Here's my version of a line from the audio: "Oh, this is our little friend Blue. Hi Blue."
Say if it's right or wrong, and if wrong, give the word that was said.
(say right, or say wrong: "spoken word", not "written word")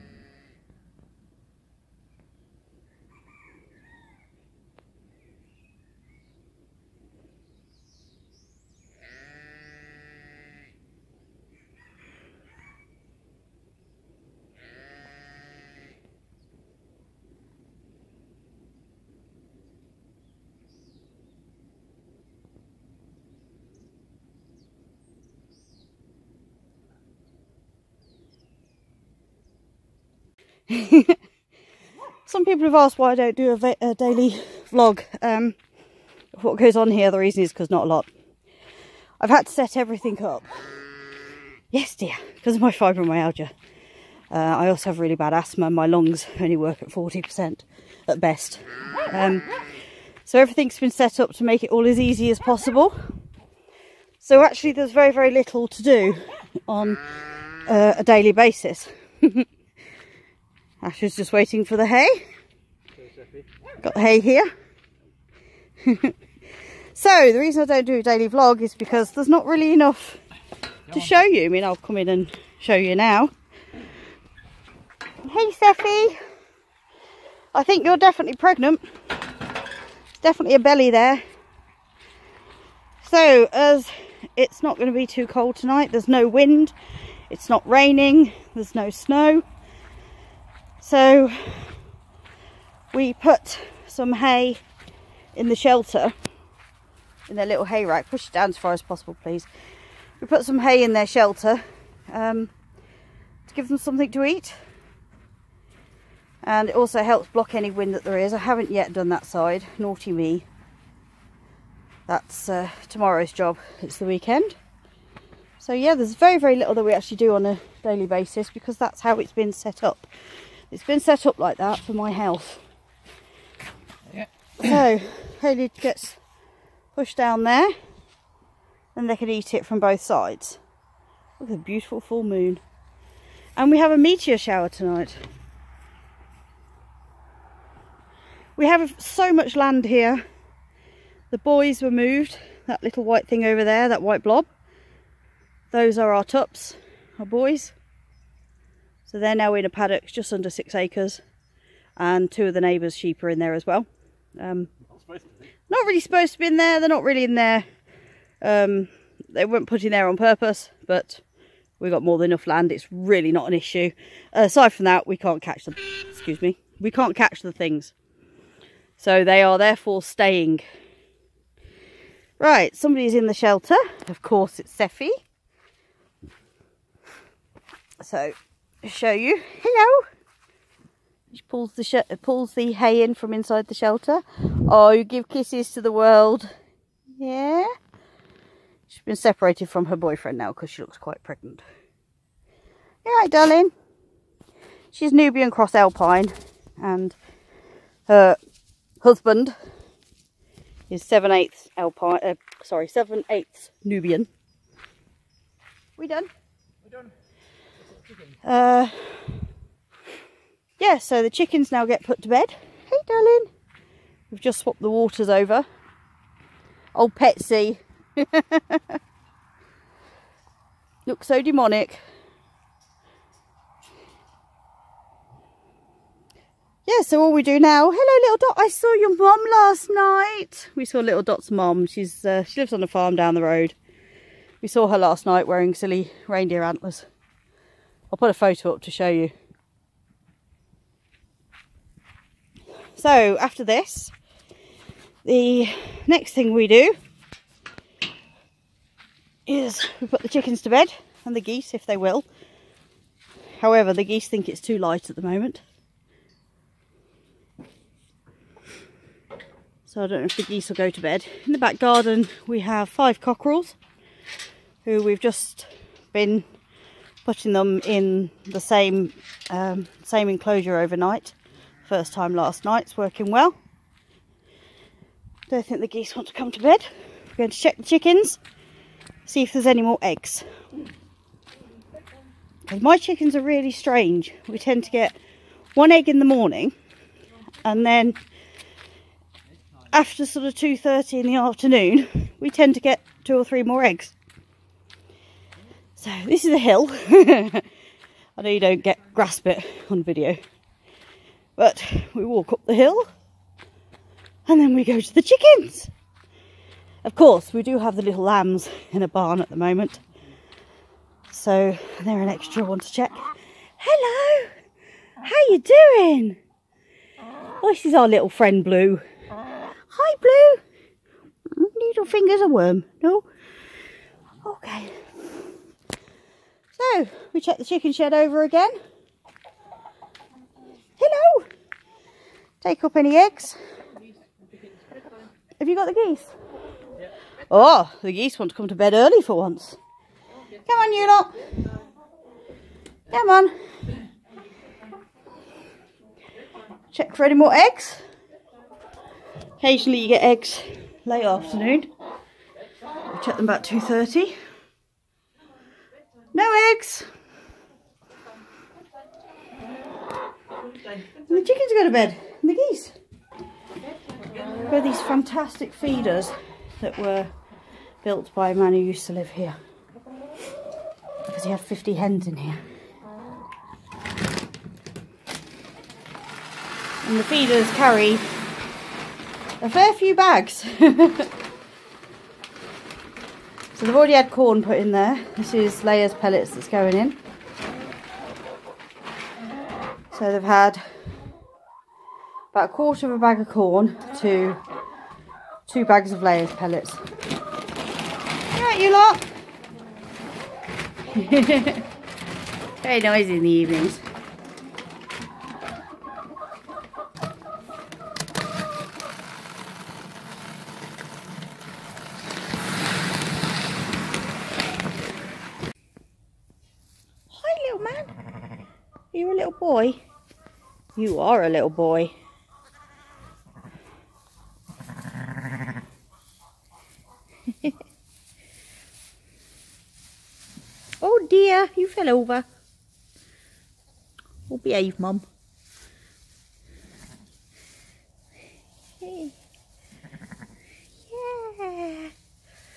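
right.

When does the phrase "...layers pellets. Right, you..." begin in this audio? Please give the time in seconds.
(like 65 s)
396 s.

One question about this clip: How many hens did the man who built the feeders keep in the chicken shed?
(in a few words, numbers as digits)
50.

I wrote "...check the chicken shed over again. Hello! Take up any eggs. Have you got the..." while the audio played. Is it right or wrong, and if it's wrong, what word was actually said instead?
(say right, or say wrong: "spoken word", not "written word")
right.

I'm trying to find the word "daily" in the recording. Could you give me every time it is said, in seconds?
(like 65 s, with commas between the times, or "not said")
33 s, 58 s, 68 s, 117 s.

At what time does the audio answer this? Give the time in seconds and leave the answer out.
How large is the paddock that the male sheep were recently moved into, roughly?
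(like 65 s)
150 s.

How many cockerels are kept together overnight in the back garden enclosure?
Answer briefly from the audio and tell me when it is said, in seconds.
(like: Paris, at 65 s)
5, at 262 s.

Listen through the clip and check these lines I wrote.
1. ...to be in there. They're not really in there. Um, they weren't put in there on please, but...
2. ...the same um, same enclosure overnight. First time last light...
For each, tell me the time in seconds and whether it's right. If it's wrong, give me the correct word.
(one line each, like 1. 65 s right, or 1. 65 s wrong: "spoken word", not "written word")
1. 156 s wrong: "purpose", not "please"
2. 268 s wrong: "night", not "light".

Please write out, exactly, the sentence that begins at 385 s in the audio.
This is layers pellets that's going in.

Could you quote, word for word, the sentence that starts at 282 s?
Because my chickens are really strange.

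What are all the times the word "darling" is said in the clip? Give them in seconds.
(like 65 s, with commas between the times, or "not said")
193 s, 213 s.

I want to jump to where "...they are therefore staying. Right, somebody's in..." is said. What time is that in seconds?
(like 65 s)
169 s.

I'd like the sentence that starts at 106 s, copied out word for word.
And it also helps block any wind that there is.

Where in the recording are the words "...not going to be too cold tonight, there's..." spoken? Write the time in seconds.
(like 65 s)
84 s.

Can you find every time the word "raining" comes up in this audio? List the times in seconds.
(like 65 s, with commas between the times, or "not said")
87 s.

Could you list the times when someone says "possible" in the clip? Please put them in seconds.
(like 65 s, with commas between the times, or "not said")
52 s, 98 s.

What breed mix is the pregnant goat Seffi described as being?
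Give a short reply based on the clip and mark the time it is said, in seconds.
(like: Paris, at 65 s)
Nubian Cross Alpine, at 195 s.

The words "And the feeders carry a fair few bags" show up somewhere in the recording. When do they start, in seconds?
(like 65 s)
377 s.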